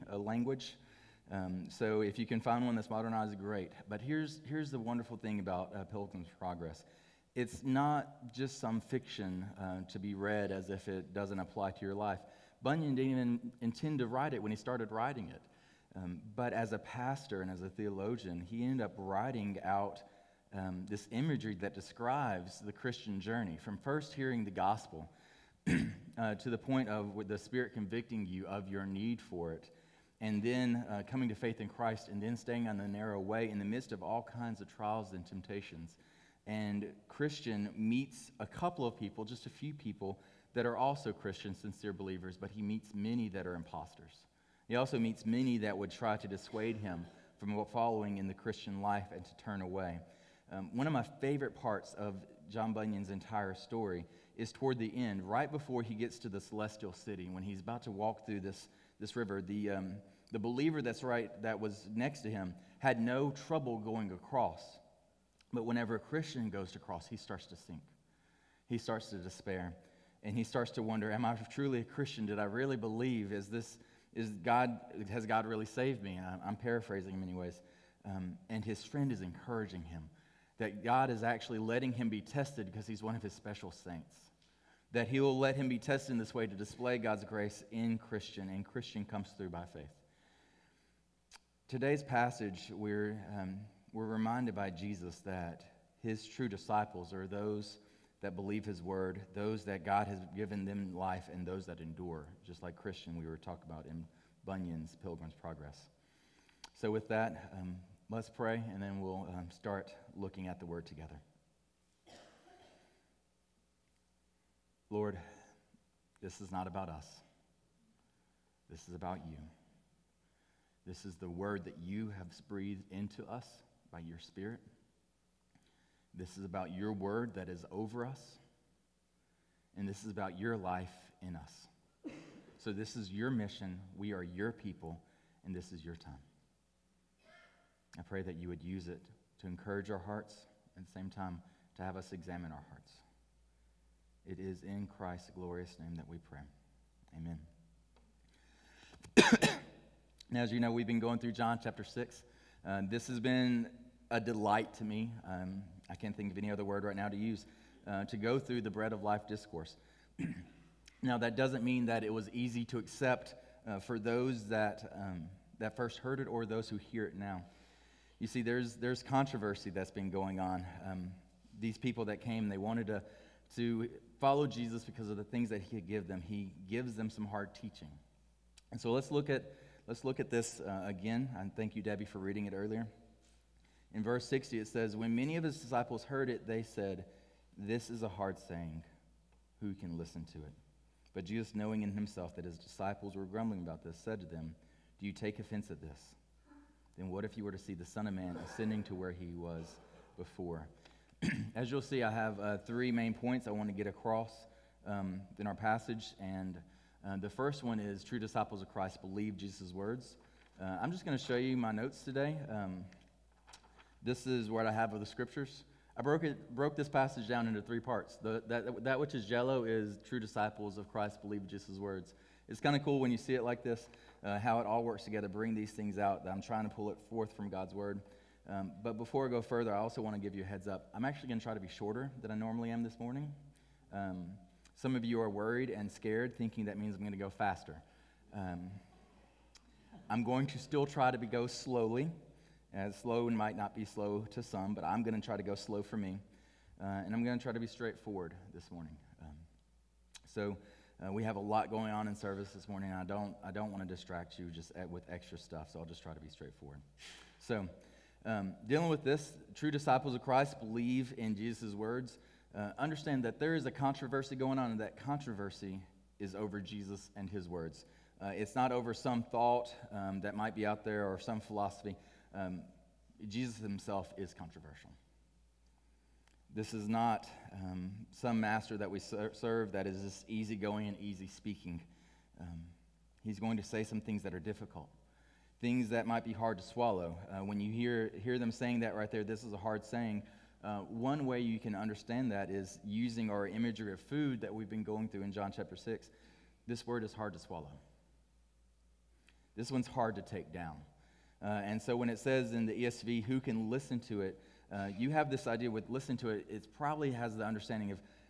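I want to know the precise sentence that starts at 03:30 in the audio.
Uh, I'm just going to show you my notes today.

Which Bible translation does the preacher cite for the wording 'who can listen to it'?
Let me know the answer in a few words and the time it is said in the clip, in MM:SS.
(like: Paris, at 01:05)
ESV, at 05:02.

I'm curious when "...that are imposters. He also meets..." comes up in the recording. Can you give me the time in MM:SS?
00:43.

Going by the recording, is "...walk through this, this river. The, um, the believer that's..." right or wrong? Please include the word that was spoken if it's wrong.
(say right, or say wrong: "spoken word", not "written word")
right.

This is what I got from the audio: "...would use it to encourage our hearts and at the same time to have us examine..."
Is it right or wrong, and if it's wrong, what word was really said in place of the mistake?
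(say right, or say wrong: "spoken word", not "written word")
right.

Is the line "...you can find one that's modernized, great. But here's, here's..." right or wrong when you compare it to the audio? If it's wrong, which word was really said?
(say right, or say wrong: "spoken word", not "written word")
right.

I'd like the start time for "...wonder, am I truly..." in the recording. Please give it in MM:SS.
01:10.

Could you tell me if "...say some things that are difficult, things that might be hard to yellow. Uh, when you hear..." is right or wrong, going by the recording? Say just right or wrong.
wrong.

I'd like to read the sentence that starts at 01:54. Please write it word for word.
Lord, this is not about us.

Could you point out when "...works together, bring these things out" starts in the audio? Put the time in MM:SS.
03:44.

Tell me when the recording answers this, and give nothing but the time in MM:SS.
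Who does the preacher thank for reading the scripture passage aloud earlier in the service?
03:01.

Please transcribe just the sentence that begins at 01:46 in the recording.
So, with that, um, Let's pray, and then we'll um, start looking at the word together.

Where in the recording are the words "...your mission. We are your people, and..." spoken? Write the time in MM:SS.
02:13.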